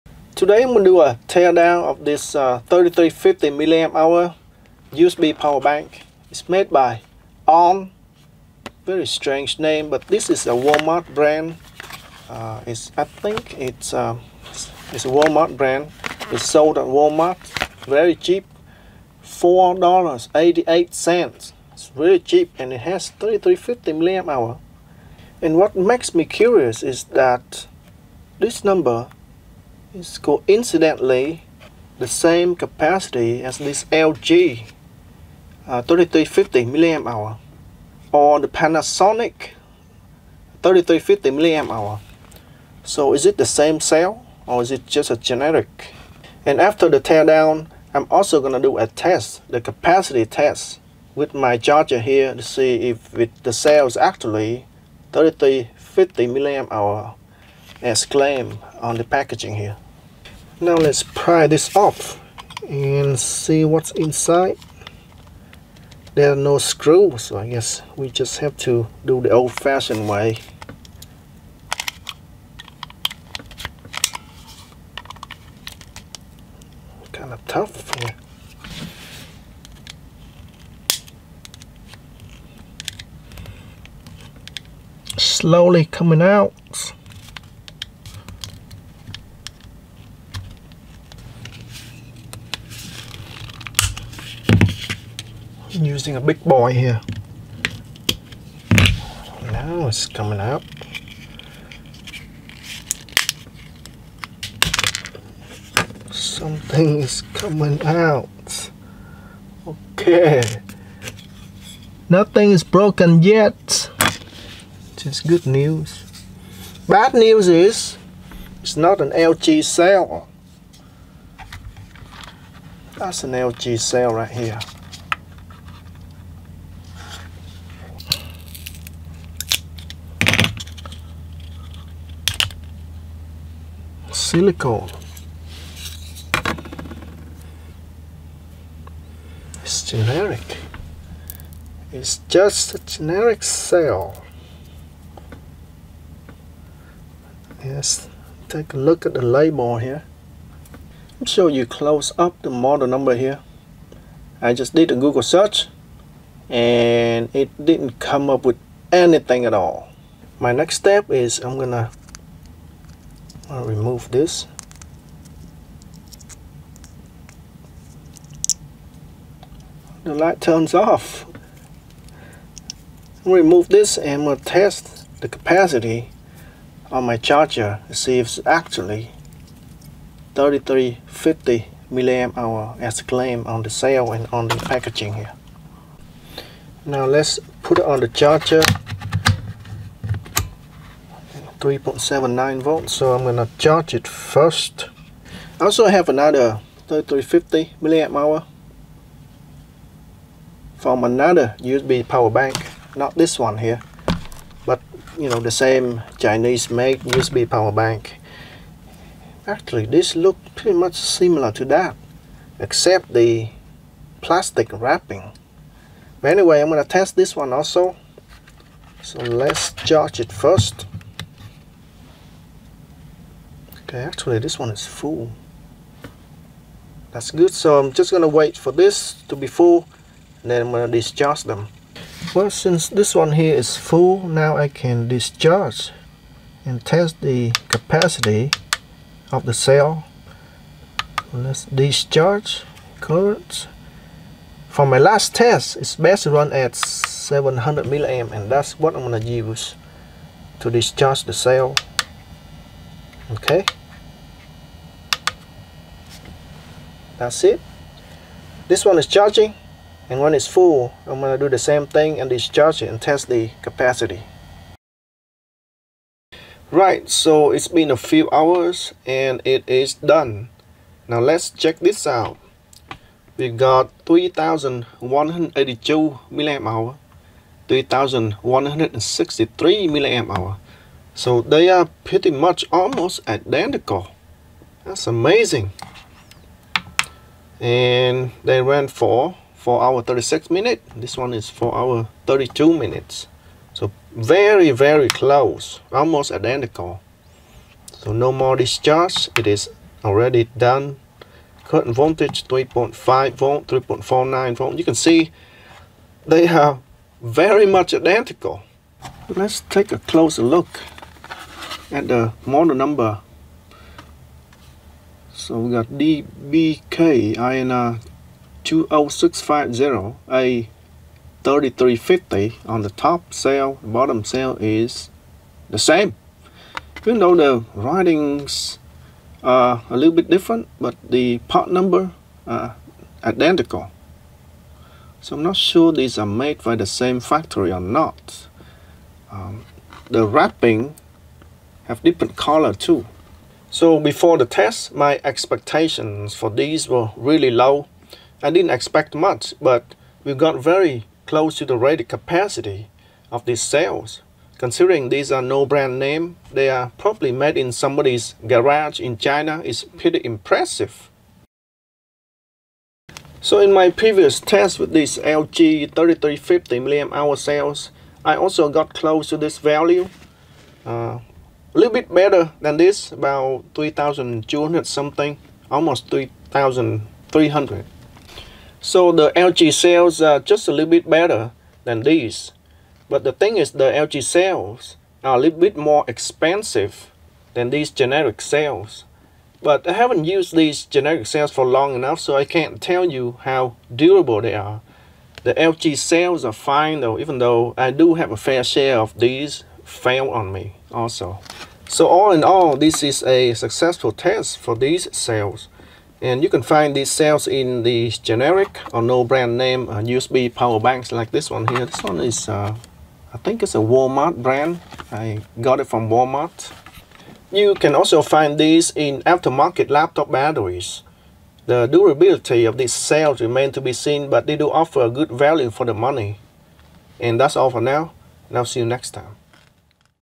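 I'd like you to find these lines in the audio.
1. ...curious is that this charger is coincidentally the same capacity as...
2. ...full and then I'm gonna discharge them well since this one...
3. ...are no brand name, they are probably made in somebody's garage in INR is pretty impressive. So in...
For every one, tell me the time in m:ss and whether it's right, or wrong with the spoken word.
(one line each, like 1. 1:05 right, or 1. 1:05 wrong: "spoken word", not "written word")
1. 0:26 wrong: "number", not "charger"
2. 3:49 right
3. 5:55 wrong: "China", not "INR".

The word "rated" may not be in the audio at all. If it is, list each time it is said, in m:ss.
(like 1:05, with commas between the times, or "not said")
5:51.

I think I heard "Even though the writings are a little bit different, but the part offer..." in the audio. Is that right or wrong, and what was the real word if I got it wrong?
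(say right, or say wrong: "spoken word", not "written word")
wrong: "number", not "offer".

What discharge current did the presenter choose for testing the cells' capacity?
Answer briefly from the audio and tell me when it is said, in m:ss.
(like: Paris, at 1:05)
700 milliamp, at 4:06.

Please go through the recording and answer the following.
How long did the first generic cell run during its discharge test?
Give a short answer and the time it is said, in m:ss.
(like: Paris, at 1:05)
4 hours 36 minutes, at 4:49.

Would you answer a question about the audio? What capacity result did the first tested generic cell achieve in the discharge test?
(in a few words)
3182 mAh.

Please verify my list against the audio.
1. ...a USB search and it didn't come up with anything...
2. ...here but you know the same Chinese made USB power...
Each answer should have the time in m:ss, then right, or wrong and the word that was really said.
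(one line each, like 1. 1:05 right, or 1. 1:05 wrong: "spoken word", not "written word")
1. 2:34 wrong: "Google", not "USB"
2. 3:23 right.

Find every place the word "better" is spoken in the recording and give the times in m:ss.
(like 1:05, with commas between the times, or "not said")
6:12, 6:21.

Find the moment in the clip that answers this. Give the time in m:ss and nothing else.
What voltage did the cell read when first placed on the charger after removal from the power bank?
3:11.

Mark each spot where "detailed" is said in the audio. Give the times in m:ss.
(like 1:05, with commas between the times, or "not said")
not said.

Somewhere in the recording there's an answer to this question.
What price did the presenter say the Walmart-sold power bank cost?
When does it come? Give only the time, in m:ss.
0:19.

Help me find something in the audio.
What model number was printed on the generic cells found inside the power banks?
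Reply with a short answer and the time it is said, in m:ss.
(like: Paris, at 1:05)
DBK INR 20650A, at 5:15.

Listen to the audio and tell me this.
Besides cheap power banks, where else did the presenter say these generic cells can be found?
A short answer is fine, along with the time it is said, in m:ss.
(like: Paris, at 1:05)
aftermarket laptop batteries, at 6:59.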